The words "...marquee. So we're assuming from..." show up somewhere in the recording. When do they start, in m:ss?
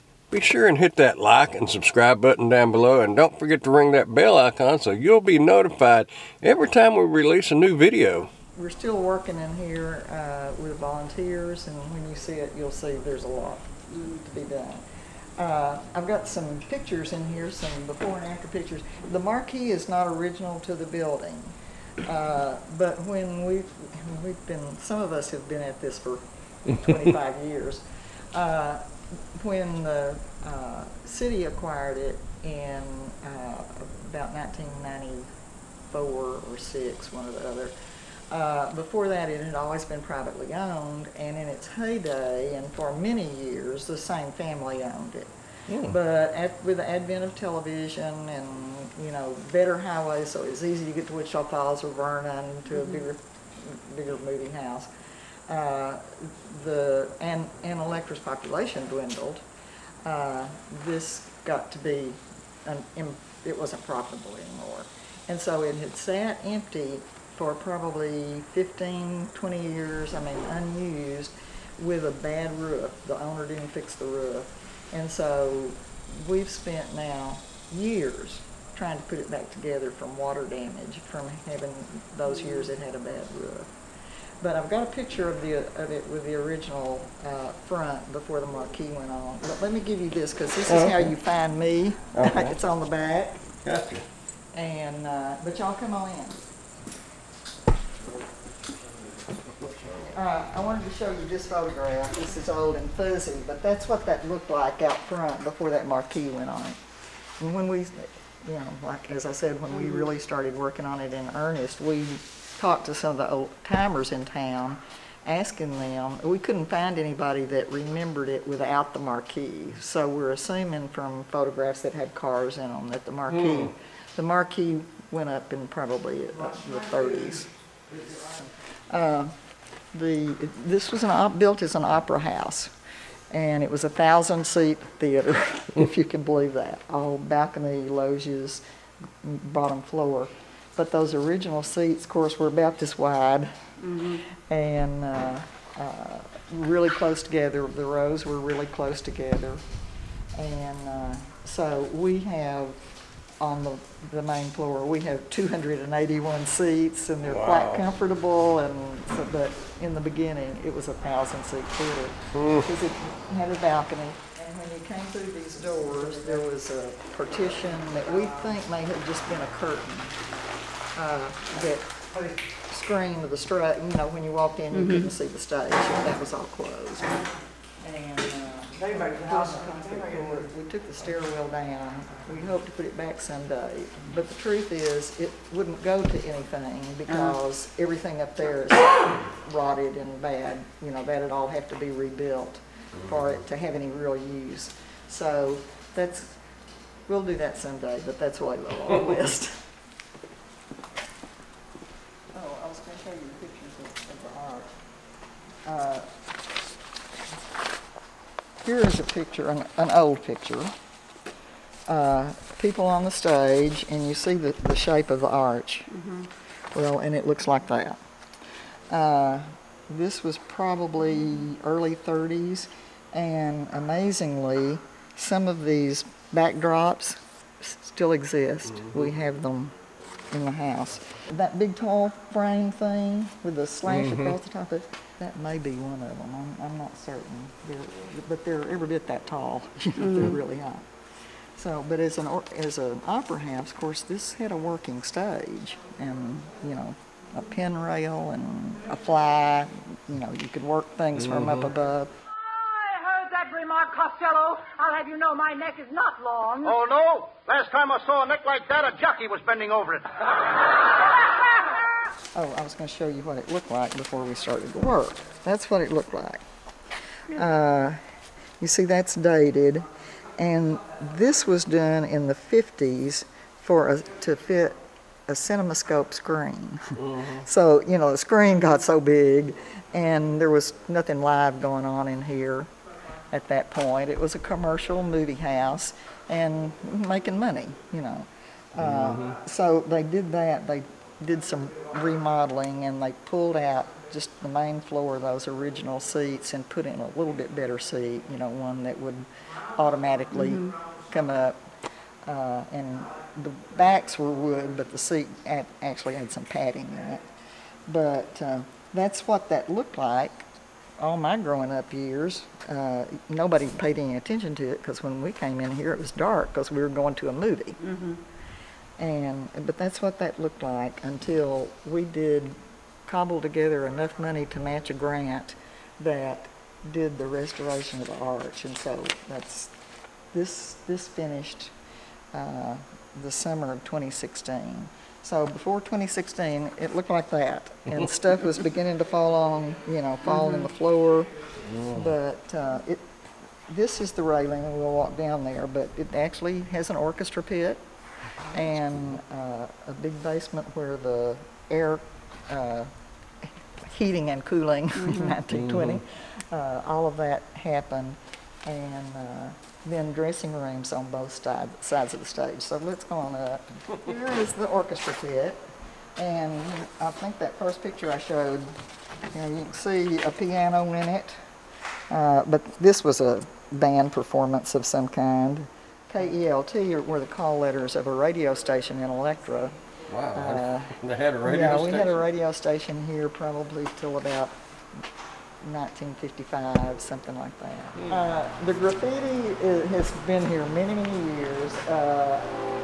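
1:59.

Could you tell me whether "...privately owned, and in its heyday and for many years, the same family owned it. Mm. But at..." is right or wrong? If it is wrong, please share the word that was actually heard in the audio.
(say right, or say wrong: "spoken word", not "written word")
right.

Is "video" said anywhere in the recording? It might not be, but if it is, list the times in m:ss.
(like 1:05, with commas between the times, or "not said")
0:07.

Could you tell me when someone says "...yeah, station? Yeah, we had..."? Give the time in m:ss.
6:21.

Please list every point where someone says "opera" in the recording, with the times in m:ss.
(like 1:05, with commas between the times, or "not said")
2:11, 4:03.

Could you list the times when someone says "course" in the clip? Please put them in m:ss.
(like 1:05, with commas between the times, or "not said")
2:22, 4:03.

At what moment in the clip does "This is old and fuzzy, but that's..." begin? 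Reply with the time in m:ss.
1:42.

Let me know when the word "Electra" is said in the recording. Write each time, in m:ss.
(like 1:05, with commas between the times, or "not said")
0:57, 6:19.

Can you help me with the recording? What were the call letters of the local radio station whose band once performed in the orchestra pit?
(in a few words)
KELT.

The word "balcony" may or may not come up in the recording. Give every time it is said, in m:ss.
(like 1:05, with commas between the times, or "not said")
2:17, 2:43.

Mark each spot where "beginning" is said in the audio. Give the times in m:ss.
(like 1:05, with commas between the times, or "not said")
2:40, 5:38.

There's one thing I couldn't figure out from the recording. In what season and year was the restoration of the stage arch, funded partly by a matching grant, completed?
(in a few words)
Summer of 2016.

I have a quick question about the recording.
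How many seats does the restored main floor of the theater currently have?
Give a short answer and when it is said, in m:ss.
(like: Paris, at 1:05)
281, at 2:35.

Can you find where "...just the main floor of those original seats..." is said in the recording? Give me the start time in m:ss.
4:54.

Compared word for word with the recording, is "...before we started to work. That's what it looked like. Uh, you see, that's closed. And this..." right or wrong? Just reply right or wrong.
wrong.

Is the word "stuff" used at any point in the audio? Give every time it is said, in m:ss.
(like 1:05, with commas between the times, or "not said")
5:38.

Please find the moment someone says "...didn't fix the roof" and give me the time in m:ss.
1:13.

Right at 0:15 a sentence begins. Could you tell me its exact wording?
Uh, I've got some pictures in here, some before and after pictures.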